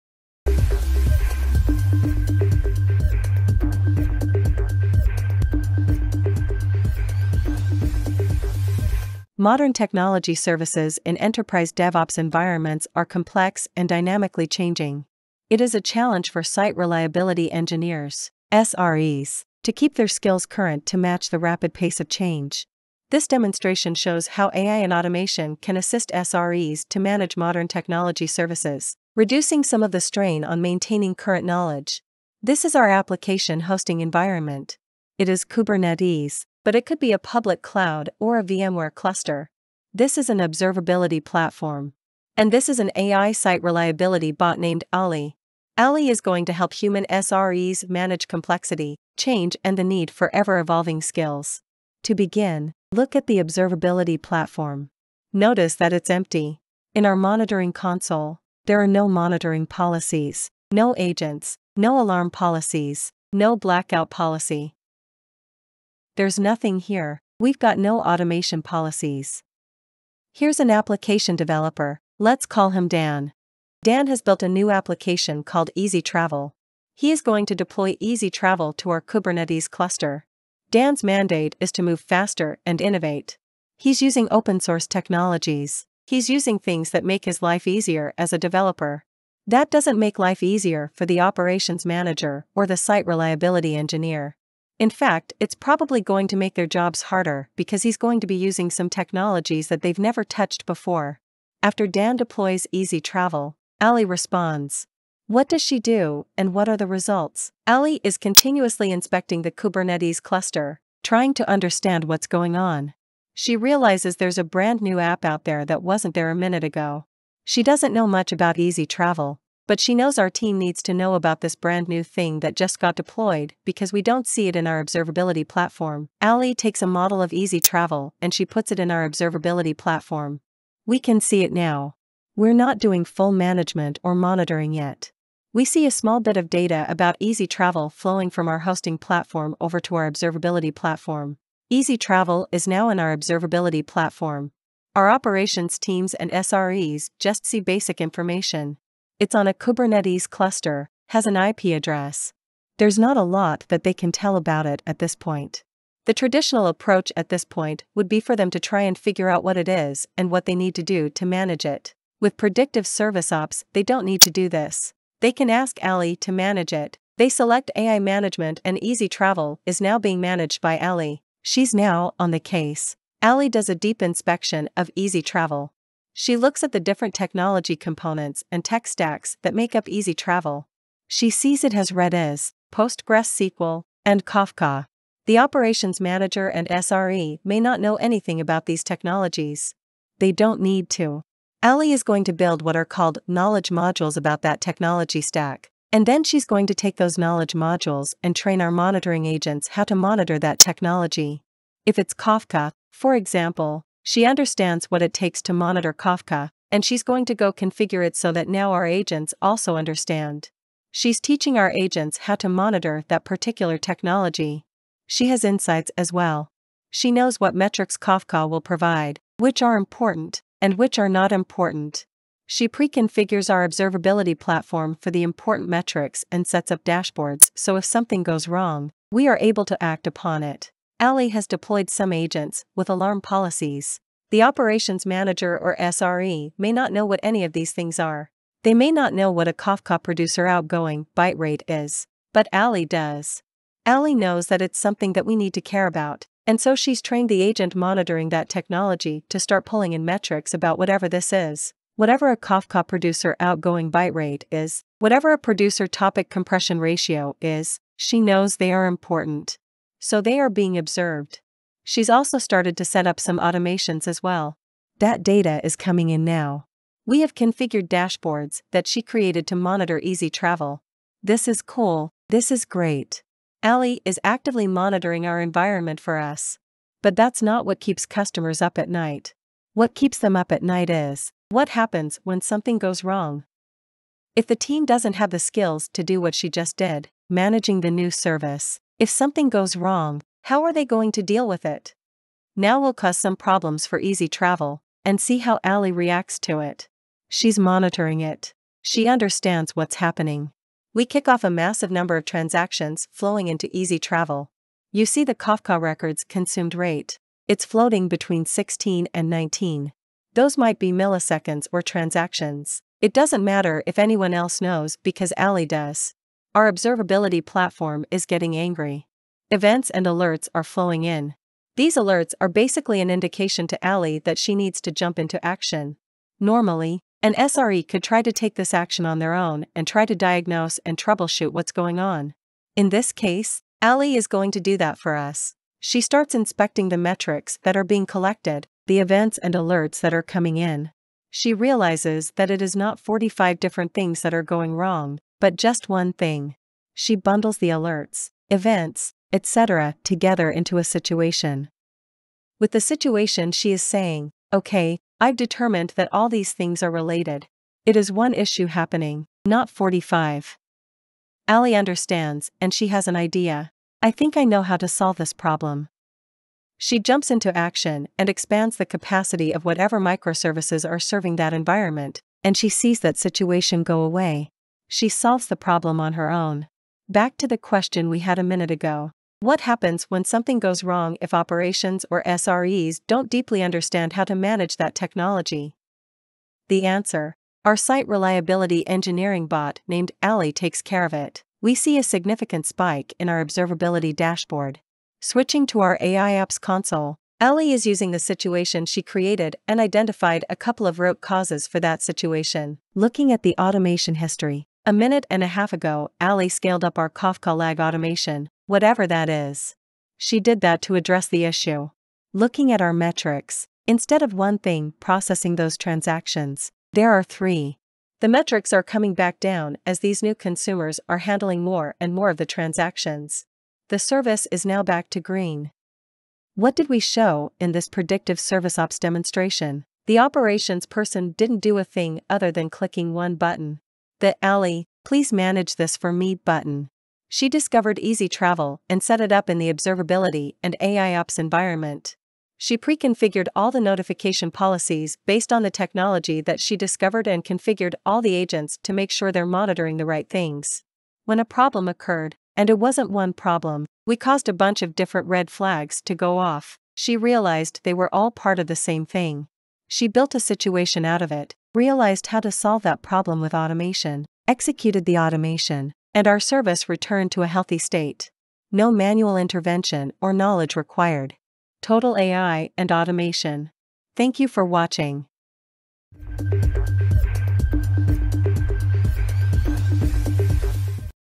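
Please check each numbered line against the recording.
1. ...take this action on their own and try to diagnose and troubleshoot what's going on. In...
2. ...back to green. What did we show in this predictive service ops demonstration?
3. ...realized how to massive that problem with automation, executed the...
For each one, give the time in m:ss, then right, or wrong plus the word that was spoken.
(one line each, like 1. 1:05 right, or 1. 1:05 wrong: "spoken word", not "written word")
1. 5:28 right
2. 7:04 right
3. 7:41 wrong: "solve", not "massive".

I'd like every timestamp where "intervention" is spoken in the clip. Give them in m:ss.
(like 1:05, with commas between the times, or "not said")
7:49.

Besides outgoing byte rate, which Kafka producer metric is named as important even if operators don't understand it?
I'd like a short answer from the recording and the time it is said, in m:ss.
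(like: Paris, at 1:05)
producer topic compression ratio, at 4:15.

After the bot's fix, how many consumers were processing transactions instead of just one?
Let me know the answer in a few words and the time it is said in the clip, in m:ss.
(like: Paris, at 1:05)
3, at 6:57.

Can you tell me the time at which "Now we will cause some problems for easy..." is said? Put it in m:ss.
4:52.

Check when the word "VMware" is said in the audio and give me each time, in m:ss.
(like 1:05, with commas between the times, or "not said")
0:38.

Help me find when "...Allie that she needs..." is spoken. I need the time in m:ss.
5:23.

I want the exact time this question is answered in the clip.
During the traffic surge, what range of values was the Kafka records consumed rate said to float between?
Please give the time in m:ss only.
5:08.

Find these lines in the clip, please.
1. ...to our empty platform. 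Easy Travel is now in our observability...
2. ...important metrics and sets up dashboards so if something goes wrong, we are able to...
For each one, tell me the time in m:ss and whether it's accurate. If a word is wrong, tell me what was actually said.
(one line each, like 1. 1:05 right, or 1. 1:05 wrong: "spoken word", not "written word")
1. 2:19 wrong: "observability", not "empty"
2. 3:45 right.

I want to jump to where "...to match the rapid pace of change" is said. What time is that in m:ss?
0:20.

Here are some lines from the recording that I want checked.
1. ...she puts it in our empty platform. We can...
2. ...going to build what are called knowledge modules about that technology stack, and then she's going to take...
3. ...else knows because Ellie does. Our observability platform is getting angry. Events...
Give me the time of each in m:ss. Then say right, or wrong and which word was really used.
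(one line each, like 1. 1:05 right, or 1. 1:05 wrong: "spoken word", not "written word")
1. 2:08 wrong: "observability", not "empty"
2. 3:12 right
3. 5:14 wrong: "Ali", not "Ellie".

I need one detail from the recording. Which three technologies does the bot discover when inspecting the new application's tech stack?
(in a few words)
Redis, SQL, and Kafka.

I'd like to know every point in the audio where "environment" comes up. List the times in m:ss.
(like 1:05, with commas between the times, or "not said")
0:12, 0:34, 4:35, 6:11, 7:21.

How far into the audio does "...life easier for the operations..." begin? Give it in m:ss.
1:30.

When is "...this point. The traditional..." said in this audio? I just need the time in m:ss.
2:34.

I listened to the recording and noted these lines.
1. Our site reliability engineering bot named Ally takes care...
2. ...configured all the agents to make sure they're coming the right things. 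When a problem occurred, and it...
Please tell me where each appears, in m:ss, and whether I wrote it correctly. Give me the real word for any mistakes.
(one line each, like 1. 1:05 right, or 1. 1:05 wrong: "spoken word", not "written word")
1. 6:27 right
2. 7:27 wrong: "monitoring", not "coming".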